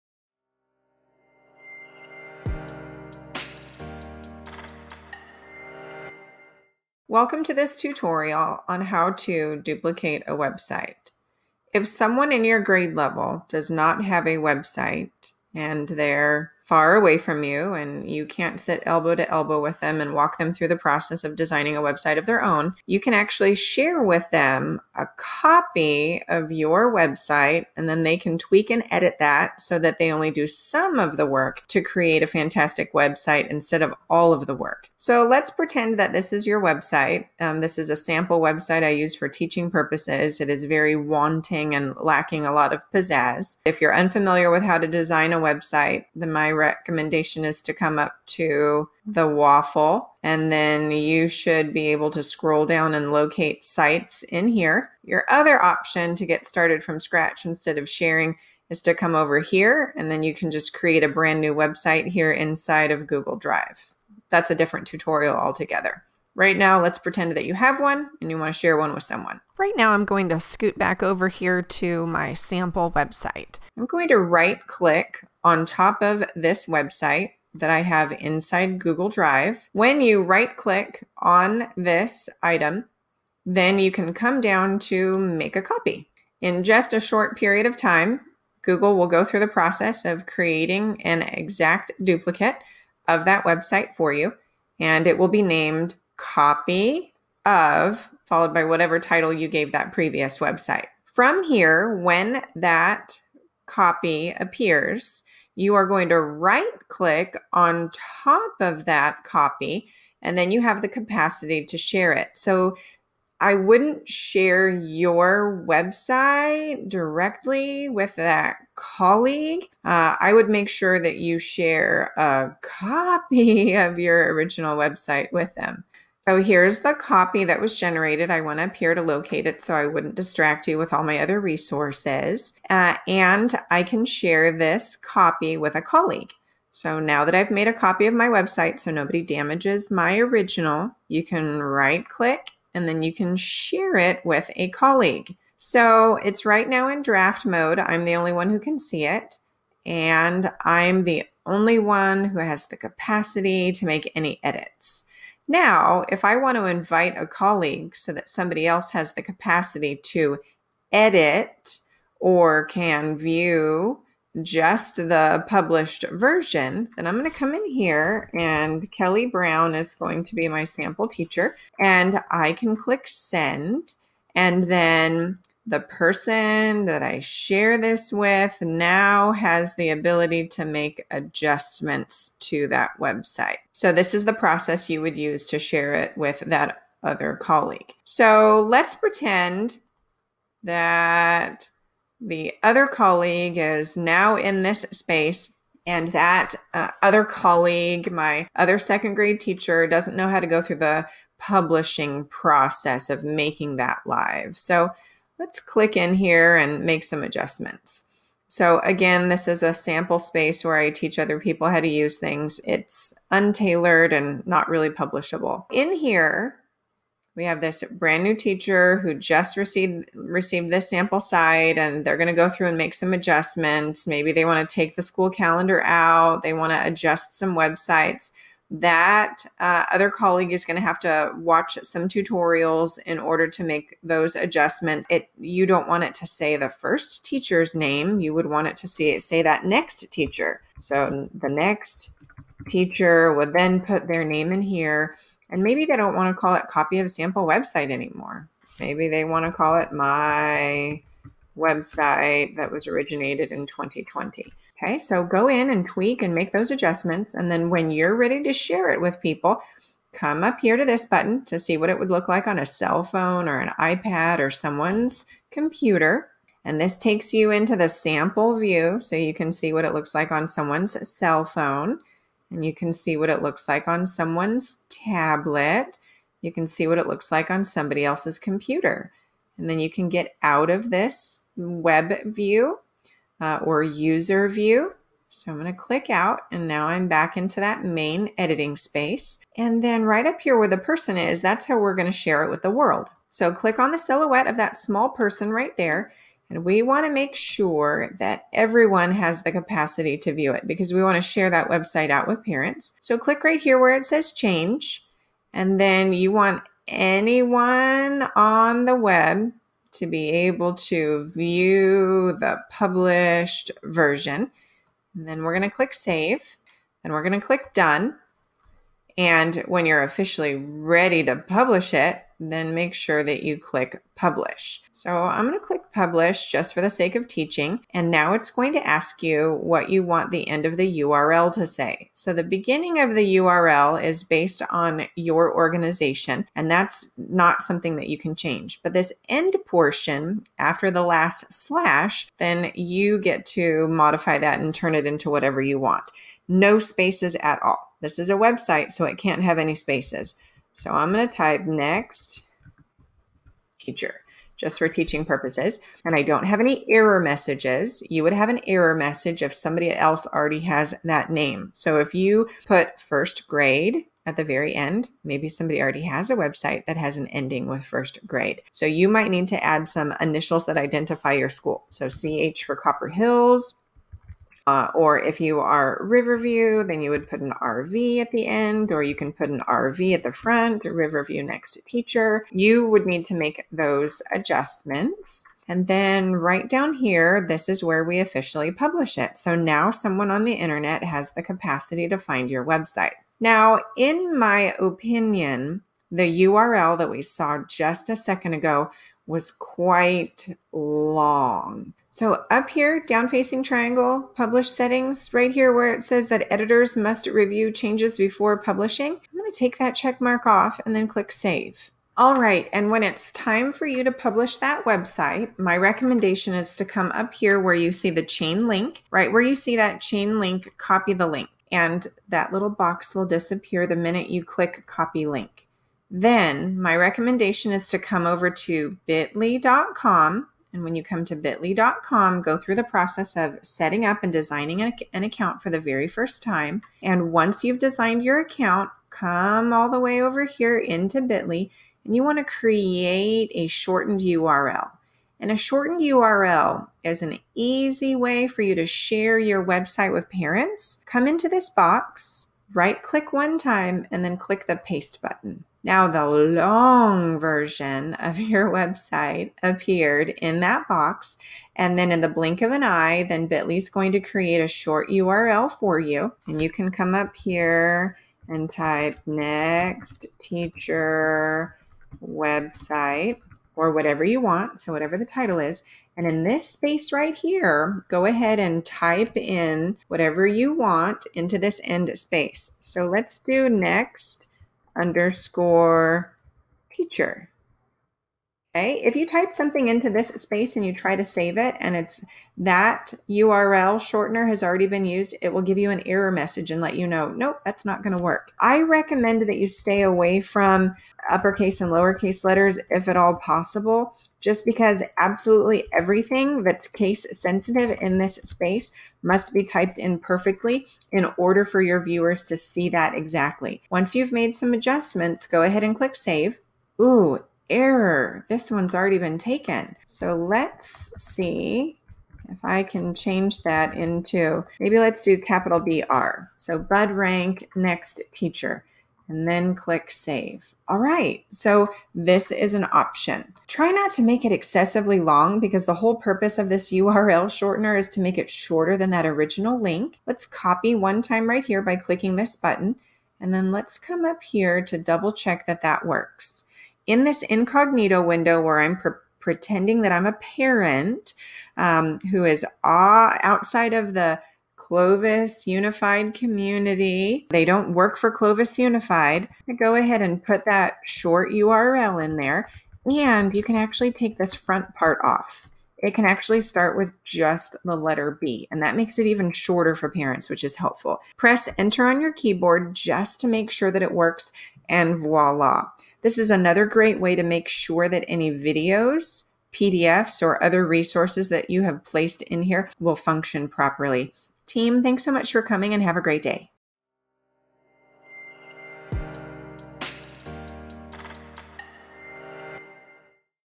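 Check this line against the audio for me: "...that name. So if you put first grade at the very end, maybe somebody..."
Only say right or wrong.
right.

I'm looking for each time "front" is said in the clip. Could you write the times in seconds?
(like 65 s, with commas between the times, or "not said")
380 s, 564 s.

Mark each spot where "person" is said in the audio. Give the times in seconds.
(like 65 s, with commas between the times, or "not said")
175 s, 290 s, 295 s.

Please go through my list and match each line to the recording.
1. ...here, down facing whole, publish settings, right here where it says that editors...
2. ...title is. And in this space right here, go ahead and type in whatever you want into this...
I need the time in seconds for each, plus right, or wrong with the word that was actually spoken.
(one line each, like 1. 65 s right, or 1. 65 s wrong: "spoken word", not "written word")
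1. 402 s wrong: "triangle", not "whole"
2. 475 s right.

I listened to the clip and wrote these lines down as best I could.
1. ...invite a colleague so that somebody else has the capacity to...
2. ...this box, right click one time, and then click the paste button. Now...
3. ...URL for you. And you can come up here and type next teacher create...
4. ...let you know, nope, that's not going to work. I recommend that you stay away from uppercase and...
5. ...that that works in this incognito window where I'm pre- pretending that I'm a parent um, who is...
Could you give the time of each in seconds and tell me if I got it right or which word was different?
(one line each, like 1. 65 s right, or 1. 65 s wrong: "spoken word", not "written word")
1. 156 s right
2. 451 s right
3. 465 s wrong: "website", not "create"
4. 496 s right
5. 545 s right.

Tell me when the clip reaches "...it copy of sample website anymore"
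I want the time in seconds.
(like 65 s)
246 s.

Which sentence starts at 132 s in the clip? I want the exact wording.
Uh, and I can share this copy with a colleague.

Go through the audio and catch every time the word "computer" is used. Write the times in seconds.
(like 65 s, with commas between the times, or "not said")
265 s, 278 s.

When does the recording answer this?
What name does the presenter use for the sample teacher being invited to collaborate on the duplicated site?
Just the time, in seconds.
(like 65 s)
168 s.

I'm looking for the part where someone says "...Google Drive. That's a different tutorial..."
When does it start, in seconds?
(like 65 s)
63 s.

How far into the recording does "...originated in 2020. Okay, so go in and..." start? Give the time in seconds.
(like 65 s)
252 s.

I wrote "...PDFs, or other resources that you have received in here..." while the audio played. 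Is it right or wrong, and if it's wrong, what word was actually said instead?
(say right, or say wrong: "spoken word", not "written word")
wrong: "placed", not "received".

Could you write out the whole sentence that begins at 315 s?
And then we're going to click save and we're going to click done.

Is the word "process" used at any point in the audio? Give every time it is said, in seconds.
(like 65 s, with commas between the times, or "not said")
20 s, 89 s, 184 s, 202 s, 432 s.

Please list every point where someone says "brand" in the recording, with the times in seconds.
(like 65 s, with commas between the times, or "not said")
61 s, 217 s.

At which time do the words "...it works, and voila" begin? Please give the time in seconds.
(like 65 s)
574 s.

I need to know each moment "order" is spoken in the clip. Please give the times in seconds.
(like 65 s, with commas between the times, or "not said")
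233 s, 511 s.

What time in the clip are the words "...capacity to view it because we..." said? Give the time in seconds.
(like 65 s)
299 s.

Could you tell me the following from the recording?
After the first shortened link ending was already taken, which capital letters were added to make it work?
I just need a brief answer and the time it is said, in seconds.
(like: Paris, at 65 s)
BR, at 525 s.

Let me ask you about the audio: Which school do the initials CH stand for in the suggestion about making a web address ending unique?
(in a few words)
Copper Hills.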